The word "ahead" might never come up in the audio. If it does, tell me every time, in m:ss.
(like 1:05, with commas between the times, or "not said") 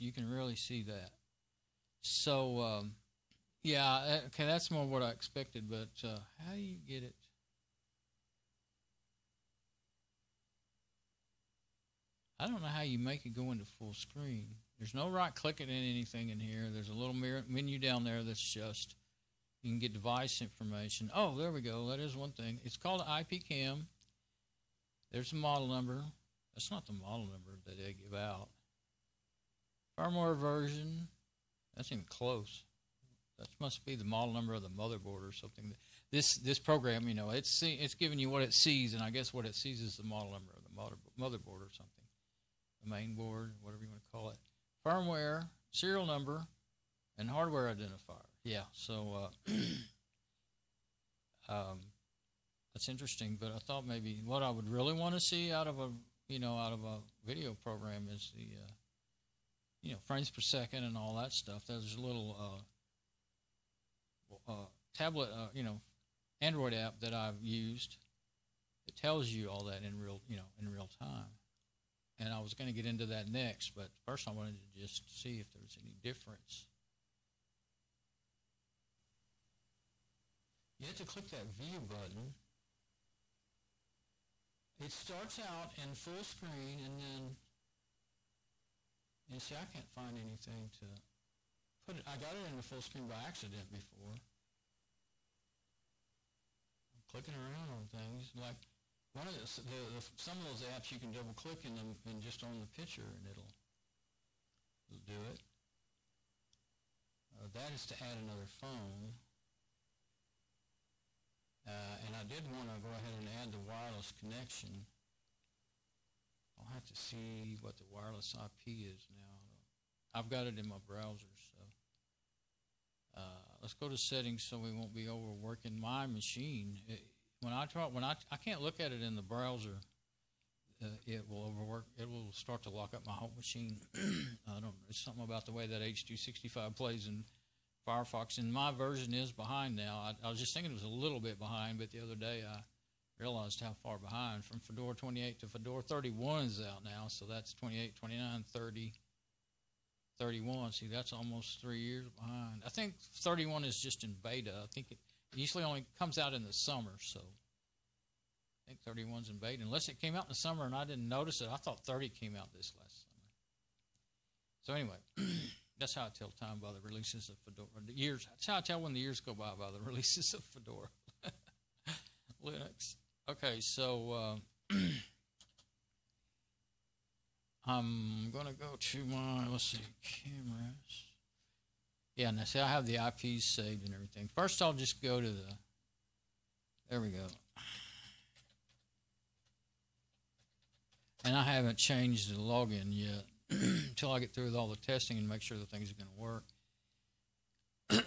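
1:52.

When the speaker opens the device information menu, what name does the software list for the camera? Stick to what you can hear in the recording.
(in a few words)
IP cam.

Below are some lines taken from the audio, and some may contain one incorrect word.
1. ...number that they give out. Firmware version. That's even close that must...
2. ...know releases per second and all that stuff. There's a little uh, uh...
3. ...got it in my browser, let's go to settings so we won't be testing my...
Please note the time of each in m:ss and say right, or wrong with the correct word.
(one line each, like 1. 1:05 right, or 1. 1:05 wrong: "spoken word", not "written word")
1. 0:27 right
2. 0:59 wrong: "frames", not "releases"
3. 2:00 wrong: "overworking", not "testing".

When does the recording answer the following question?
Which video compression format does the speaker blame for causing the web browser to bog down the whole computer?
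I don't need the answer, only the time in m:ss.
2:15.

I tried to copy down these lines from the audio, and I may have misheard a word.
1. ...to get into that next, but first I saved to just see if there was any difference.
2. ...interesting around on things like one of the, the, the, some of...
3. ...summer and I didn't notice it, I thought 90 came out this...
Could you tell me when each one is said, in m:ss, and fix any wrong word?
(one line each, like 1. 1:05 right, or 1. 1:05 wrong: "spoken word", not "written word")
1. 1:12 wrong: "wanted", not "saved"
2. 1:37 wrong: "clicking", not "interesting"
3. 2:40 wrong: "30", not "90".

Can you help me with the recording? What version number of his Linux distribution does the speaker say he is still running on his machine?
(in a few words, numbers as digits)
Fedora 28.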